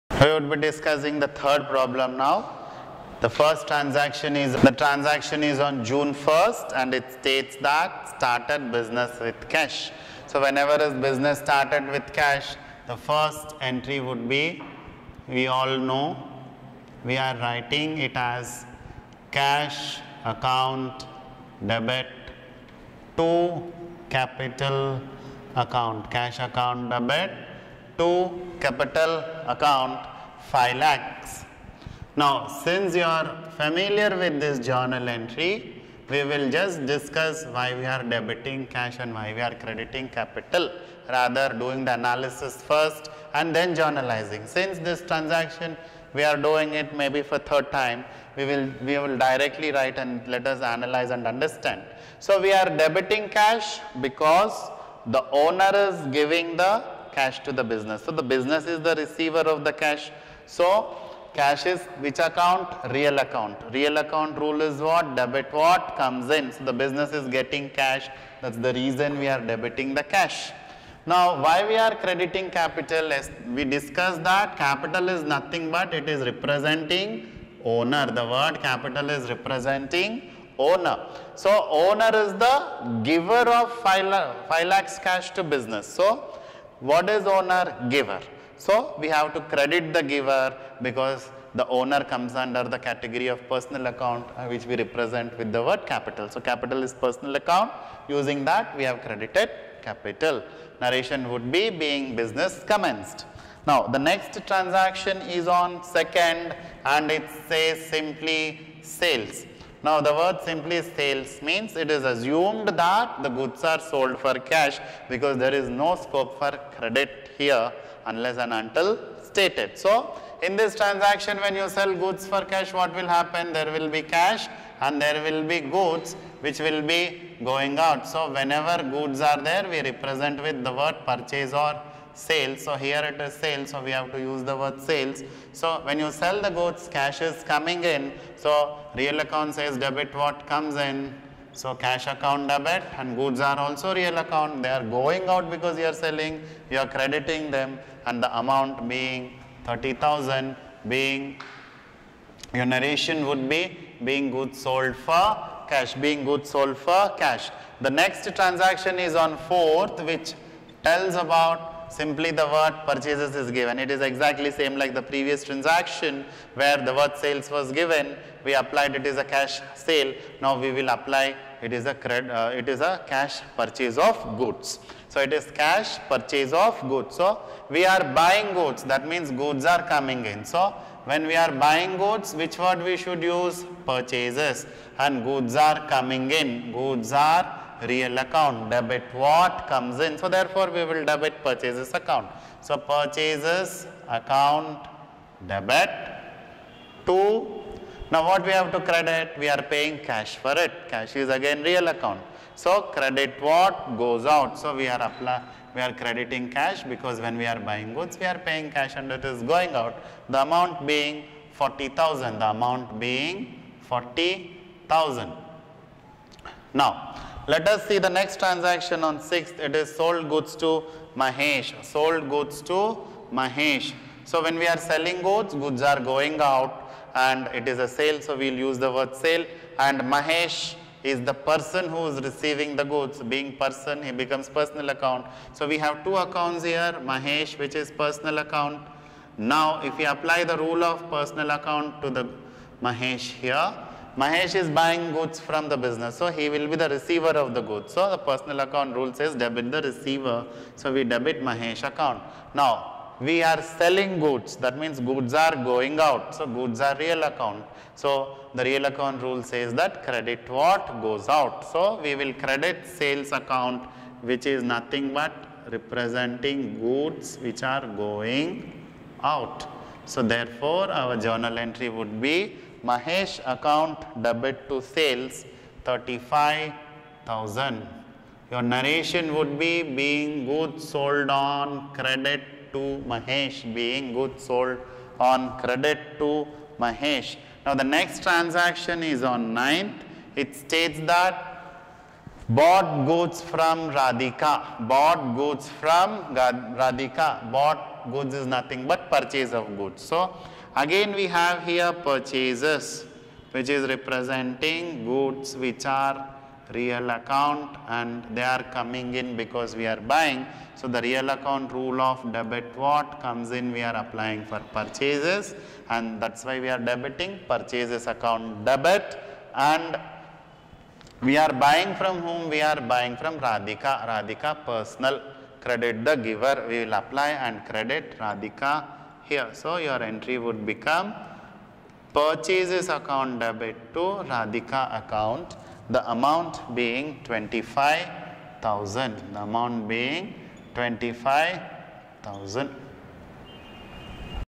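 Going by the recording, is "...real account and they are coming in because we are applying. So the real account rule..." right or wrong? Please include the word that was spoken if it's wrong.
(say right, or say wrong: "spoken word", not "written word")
wrong: "buying", not "applying".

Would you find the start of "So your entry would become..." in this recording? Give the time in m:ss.
5:29.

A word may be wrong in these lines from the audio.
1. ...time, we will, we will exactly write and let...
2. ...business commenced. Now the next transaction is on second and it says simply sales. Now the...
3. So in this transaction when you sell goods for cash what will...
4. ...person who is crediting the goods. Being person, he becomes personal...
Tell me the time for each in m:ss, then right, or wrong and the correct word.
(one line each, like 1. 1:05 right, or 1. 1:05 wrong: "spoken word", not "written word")
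1. 0:47 wrong: "directly", not "exactly"
2. 1:42 right
3. 1:59 right
4. 3:51 wrong: "receiving", not "crediting".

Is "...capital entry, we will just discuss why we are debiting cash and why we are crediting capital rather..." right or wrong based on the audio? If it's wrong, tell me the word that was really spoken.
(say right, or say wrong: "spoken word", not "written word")
wrong: "journal", not "capital".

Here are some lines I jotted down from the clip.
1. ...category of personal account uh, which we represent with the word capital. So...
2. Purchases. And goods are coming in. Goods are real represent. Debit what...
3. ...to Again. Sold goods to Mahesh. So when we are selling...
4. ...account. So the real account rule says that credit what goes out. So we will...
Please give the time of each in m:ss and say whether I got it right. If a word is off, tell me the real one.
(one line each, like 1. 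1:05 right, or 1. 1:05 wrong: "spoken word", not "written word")
1. 1:32 right
2. 3:03 wrong: "account", not "represent"
3. 3:40 wrong: "Mahesh", not "Again"
4. 4:17 right.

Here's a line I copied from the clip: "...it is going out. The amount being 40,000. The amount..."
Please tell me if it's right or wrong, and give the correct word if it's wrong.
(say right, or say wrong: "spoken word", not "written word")
right.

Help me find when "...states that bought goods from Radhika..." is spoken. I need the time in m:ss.
4:50.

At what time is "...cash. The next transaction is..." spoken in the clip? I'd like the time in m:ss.
2:37.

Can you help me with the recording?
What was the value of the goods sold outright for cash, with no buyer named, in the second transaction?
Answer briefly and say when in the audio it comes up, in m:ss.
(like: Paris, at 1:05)
30,000, at 2:29.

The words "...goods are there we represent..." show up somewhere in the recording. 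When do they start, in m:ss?
2:08.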